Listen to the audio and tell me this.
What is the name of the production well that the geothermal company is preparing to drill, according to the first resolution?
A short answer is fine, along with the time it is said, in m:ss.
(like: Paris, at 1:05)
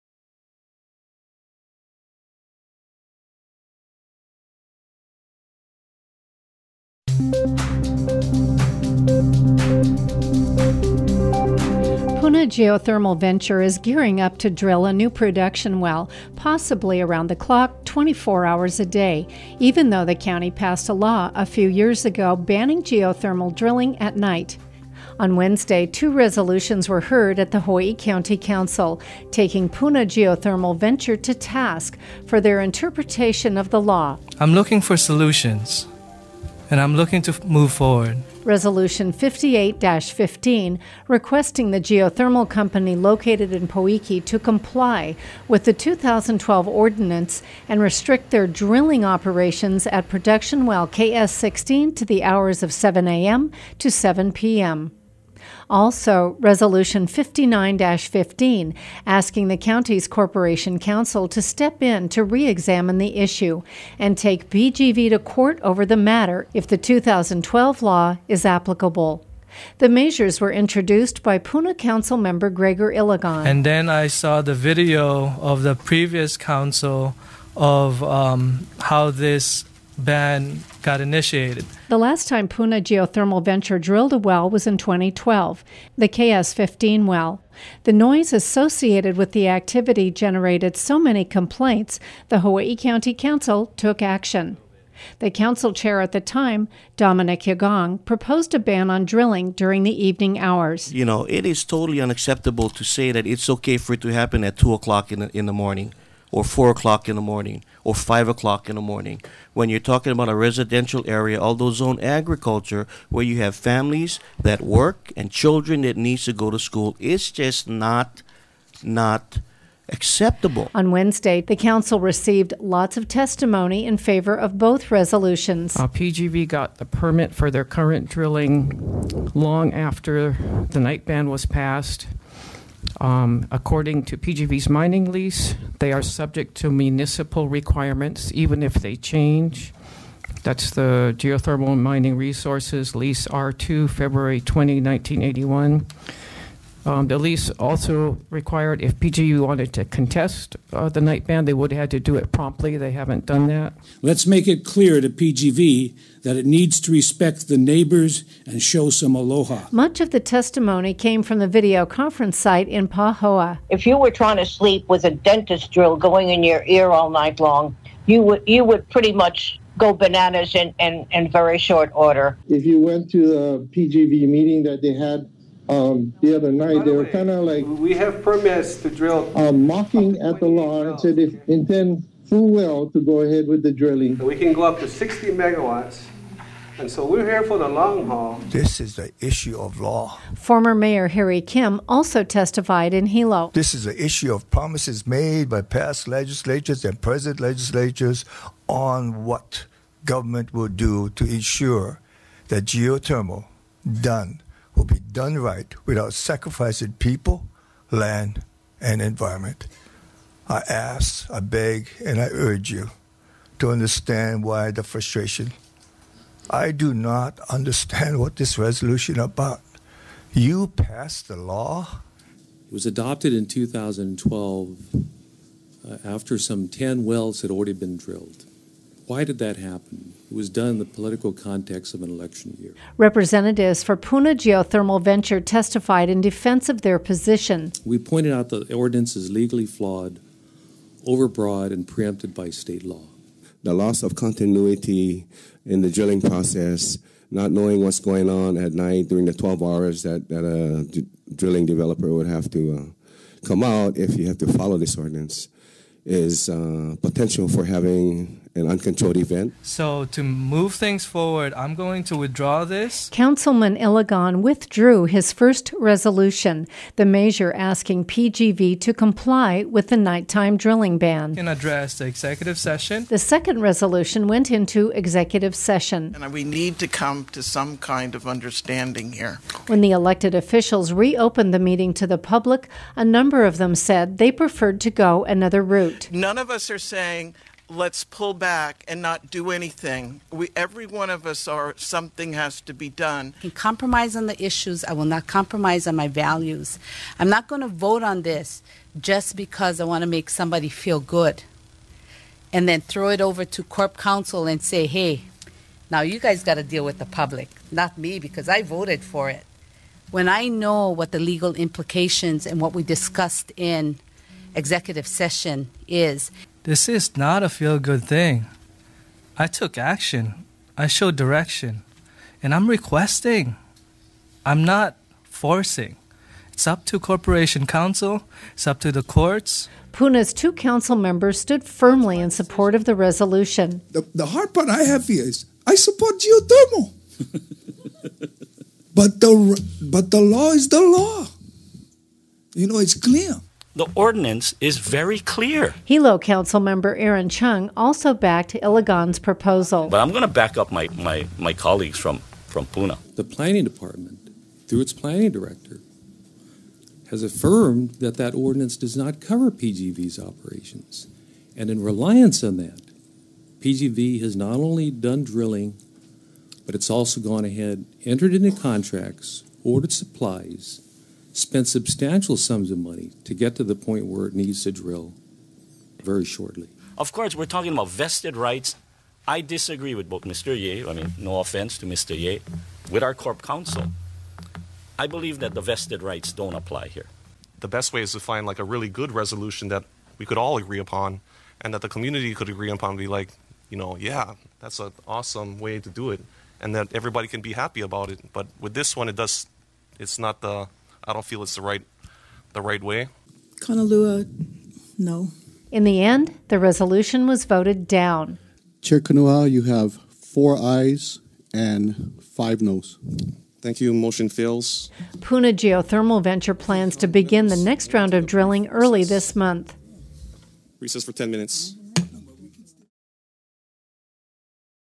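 KS 16, at 0:50.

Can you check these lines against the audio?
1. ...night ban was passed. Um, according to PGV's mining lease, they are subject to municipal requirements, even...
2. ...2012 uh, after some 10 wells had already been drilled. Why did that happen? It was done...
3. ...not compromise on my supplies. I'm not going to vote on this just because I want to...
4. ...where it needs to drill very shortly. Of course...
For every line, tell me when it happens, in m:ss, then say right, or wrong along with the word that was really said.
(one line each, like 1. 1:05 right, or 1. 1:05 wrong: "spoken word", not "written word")
1. 2:10 right
2. 3:43 right
3. 4:55 wrong: "values", not "supplies"
4. 6:14 right.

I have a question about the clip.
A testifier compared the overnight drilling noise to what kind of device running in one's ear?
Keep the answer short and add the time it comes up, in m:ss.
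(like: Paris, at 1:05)
dentist drill, at 2:45.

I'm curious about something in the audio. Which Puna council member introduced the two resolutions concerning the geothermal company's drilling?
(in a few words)
Greggor Ilagan.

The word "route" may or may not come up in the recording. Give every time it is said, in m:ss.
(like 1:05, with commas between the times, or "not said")
4:45.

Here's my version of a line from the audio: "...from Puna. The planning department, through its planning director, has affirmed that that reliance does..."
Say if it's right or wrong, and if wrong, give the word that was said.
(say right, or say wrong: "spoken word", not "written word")
wrong: "ordinance", not "reliance".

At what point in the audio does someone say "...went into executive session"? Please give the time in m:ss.
4:34.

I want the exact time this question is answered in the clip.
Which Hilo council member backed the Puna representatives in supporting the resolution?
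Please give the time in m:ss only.
5:46.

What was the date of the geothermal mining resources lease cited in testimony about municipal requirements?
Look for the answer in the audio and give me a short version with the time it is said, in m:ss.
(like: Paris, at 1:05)
February 20, 1981, at 2:23.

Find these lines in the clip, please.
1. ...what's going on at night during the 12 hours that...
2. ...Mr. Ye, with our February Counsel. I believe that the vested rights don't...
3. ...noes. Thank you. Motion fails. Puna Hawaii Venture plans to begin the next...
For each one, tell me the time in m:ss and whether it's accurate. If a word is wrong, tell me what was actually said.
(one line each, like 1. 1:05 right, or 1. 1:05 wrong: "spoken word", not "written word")
1. 4:07 right
2. 6:21 wrong: "Corp", not "February"
3. 6:52 wrong: "Geothermal", not "Hawaii".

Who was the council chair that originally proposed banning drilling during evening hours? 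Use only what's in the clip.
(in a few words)
Dominic Yagong.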